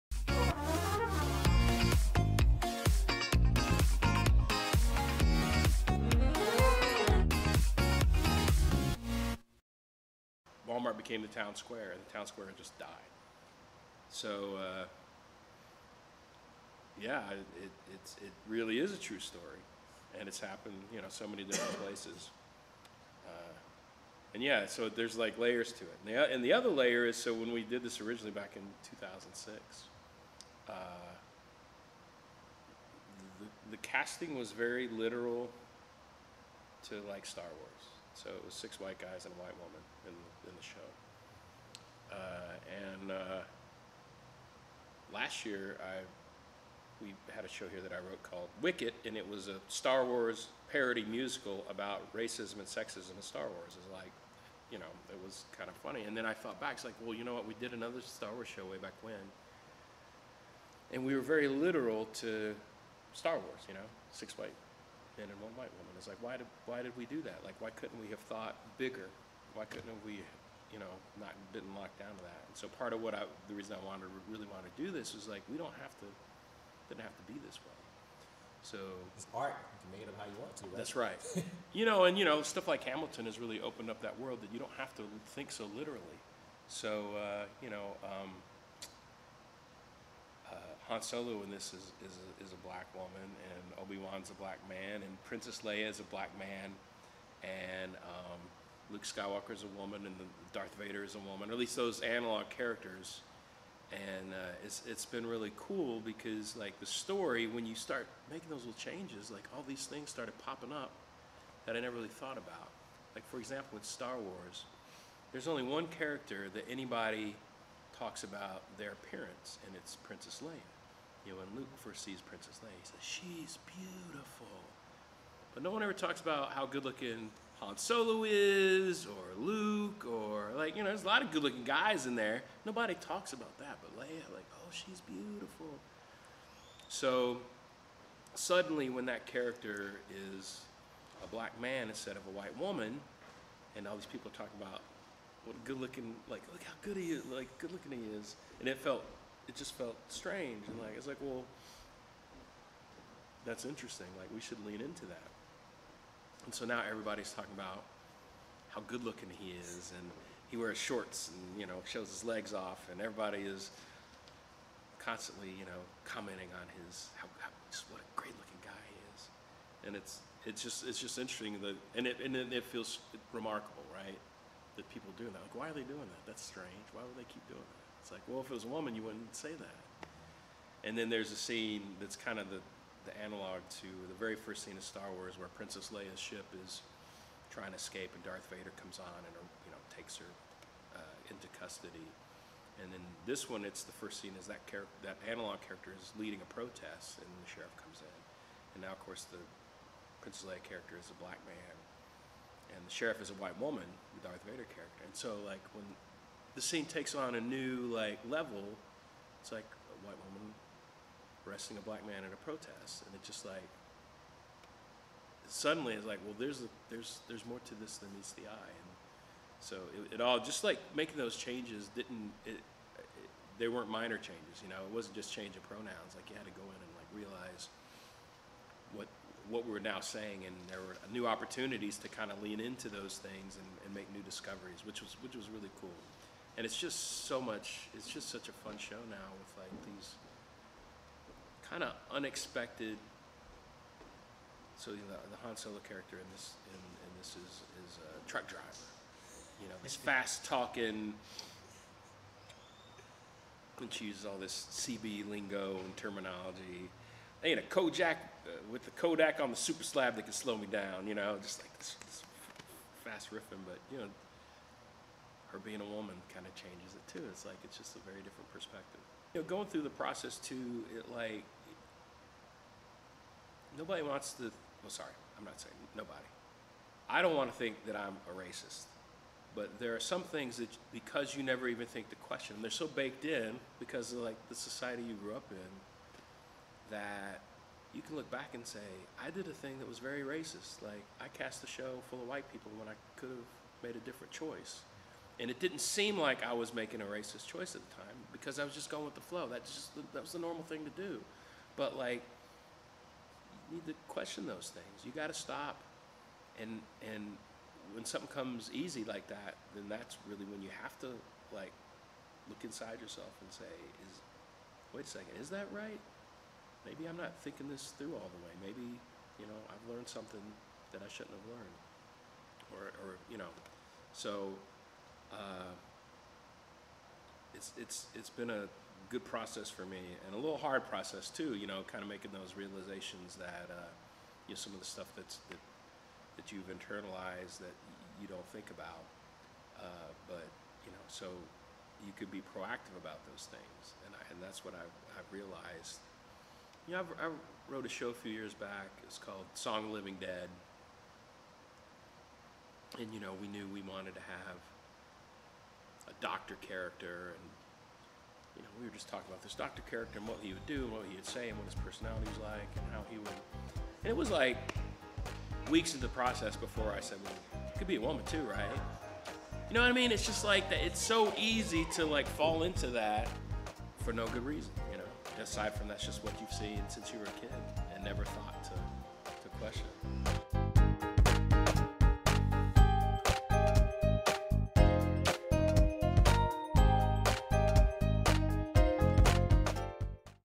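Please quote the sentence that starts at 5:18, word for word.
Maybe, you know, I've learned something that I shouldn't have learned.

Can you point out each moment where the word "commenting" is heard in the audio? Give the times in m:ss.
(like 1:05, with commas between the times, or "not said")
2:46.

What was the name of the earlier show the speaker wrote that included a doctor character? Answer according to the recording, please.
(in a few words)
Song of Living Dead.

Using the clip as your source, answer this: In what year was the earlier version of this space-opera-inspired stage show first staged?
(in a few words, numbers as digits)
2006.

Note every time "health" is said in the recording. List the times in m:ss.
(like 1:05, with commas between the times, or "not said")
not said.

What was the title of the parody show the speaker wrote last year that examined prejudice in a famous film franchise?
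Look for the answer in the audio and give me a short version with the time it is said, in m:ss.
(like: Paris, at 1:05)
Wicket, at 0:48.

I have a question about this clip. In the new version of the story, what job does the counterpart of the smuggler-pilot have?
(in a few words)
truck driver.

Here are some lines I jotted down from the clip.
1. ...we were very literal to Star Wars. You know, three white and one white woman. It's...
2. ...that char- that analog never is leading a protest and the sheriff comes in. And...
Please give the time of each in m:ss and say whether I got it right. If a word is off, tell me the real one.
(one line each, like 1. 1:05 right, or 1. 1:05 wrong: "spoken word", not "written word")
1. 1:01 wrong: "six", not "three"
2. 3:14 wrong: "character", not "never".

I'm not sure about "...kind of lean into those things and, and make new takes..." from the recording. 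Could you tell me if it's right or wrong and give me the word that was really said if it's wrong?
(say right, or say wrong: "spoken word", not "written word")
wrong: "discoveries", not "takes".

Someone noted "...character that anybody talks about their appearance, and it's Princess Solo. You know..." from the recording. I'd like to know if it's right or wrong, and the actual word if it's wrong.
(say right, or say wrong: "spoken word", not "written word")
wrong: "Leia", not "Solo".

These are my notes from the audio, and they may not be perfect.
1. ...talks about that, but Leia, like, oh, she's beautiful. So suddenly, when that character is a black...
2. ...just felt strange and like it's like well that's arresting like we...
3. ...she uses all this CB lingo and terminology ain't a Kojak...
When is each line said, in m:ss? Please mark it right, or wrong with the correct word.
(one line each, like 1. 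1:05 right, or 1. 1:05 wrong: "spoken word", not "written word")
1. 2:12 right
2. 2:29 wrong: "interesting", not "arresting"
3. 4:13 right.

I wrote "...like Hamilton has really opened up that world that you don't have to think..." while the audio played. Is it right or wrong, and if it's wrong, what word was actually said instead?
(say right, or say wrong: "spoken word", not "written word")
right.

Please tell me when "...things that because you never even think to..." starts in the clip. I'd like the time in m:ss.
4:40.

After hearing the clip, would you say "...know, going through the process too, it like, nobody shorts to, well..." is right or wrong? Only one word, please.
wrong.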